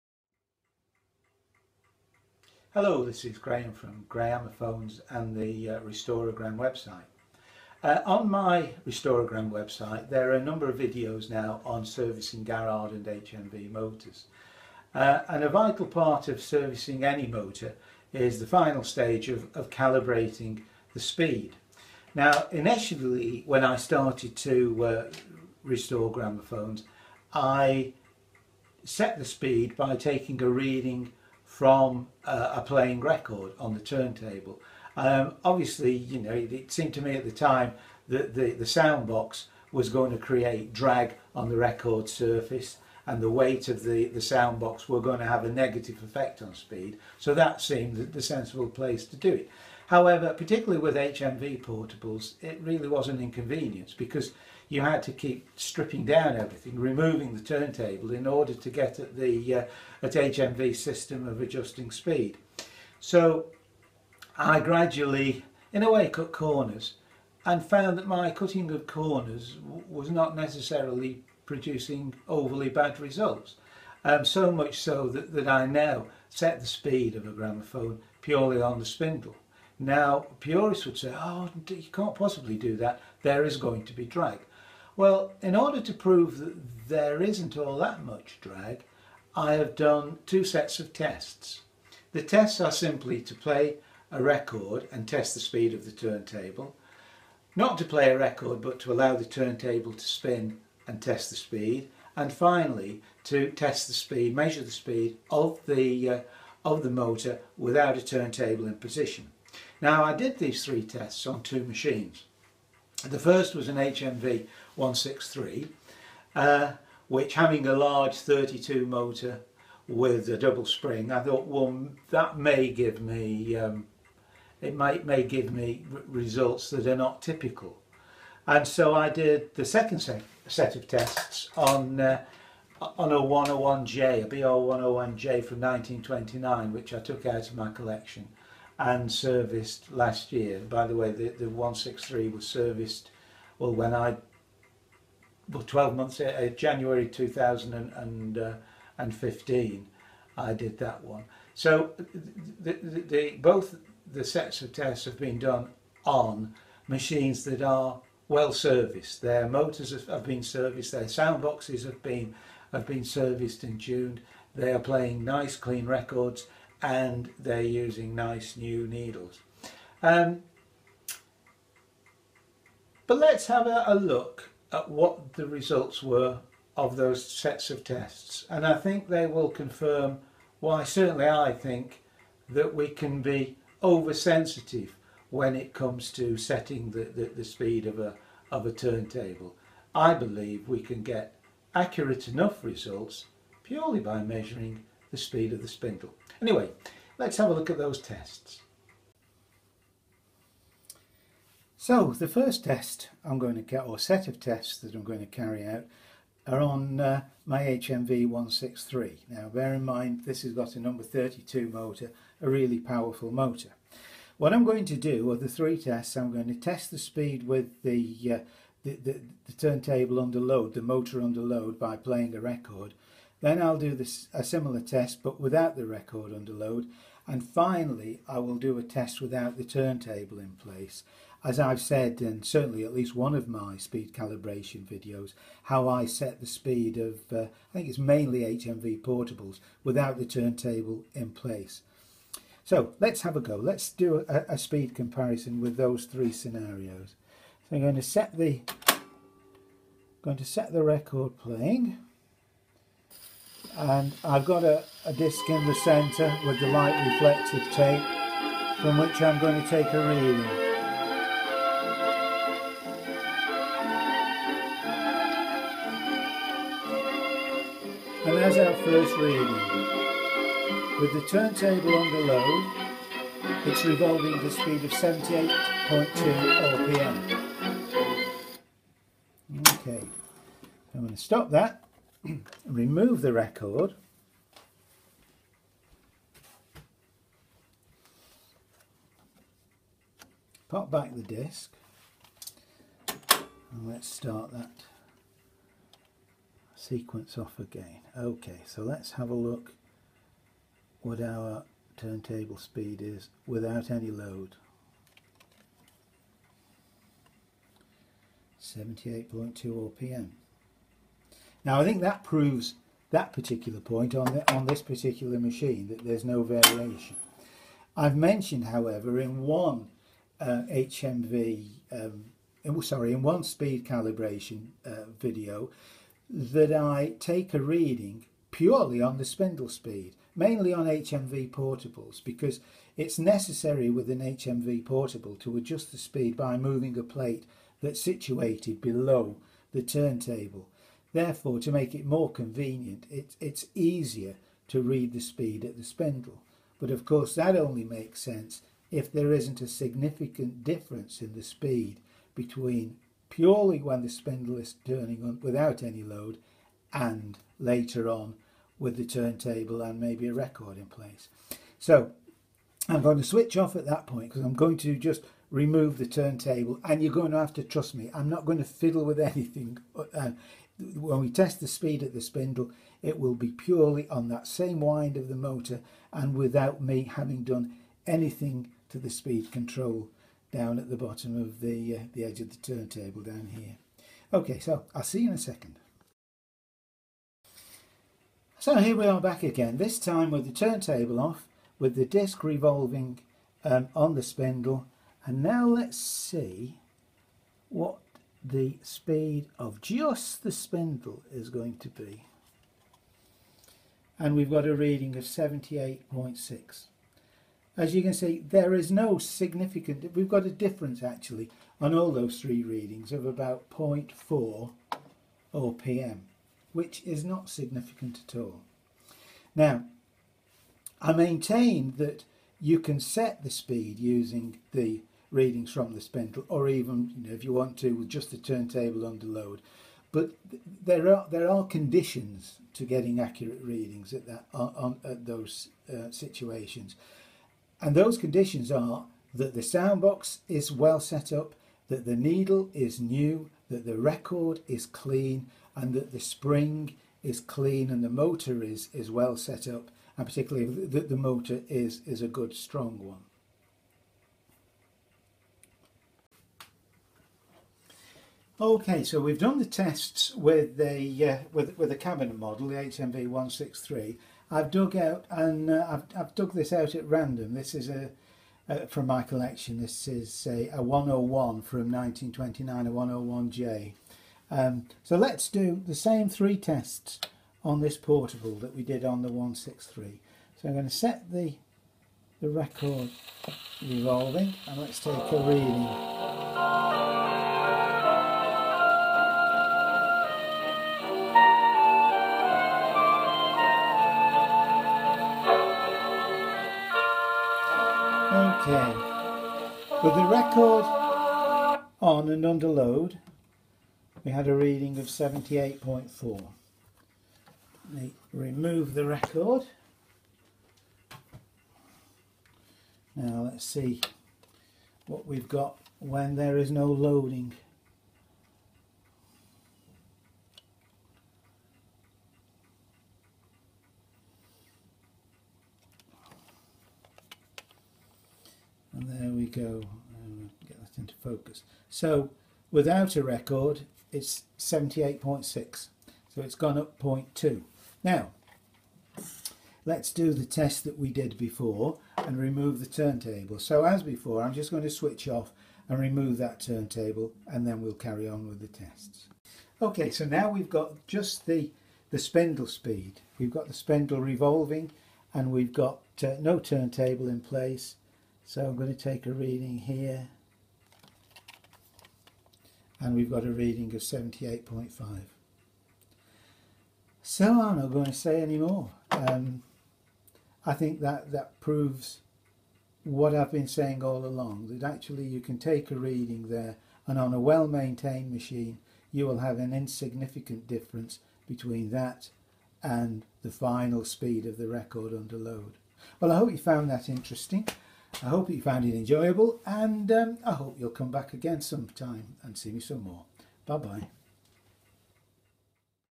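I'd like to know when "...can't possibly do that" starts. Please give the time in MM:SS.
01:21.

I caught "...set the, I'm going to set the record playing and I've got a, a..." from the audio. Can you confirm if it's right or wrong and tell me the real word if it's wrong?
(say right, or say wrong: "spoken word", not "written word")
right.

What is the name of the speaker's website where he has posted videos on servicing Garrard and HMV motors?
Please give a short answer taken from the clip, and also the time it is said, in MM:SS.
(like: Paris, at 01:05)
Restorogram, at 00:08.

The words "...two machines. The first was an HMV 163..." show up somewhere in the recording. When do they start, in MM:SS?
01:51.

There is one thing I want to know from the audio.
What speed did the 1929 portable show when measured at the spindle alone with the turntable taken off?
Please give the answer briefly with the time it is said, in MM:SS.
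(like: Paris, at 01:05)
78.5, at 09:24.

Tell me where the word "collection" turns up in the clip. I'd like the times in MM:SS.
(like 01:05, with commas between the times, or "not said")
02:17, 07:49.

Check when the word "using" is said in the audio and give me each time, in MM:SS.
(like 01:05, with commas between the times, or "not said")
02:47, 07:03.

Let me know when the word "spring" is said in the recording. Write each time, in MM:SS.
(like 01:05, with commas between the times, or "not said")
02:00, 07:26.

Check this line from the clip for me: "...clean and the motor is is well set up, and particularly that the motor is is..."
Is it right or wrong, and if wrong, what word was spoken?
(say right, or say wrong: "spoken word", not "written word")
right.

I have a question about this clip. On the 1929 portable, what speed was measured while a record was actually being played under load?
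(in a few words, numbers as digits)
78.4.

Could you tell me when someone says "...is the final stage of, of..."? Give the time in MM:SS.
00:18.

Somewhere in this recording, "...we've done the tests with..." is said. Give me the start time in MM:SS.
07:39.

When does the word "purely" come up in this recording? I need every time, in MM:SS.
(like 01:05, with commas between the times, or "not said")
01:18, 03:13, 05:28, 05:53, 06:13.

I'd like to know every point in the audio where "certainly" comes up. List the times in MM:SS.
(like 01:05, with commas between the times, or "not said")
03:00, 03:52.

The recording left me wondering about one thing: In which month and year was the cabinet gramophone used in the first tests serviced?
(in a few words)
January 2015.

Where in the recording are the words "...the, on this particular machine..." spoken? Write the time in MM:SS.
05:14.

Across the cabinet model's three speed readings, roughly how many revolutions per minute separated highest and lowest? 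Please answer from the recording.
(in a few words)
0.4.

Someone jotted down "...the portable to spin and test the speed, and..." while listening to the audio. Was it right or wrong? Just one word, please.
wrong.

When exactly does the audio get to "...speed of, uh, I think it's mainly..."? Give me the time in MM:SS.
03:56.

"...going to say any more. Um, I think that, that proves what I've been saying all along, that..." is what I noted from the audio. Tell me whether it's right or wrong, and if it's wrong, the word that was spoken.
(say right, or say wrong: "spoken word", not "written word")
right.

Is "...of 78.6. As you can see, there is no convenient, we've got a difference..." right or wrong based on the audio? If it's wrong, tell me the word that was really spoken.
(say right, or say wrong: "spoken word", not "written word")
wrong: "significant", not "convenient".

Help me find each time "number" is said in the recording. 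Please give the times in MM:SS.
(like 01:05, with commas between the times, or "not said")
00:10, 03:30.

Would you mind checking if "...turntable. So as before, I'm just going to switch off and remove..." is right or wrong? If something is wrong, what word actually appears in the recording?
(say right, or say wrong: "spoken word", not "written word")
right.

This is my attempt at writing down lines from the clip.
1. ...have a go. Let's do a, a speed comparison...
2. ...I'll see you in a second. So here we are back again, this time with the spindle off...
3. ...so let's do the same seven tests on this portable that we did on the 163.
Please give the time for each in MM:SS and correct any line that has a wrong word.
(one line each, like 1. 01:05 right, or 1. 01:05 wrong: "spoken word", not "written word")
1. 04:03 right
2. 06:24 wrong: "turntable", not "spindle"
3. 07:55 wrong: "three", not "seven".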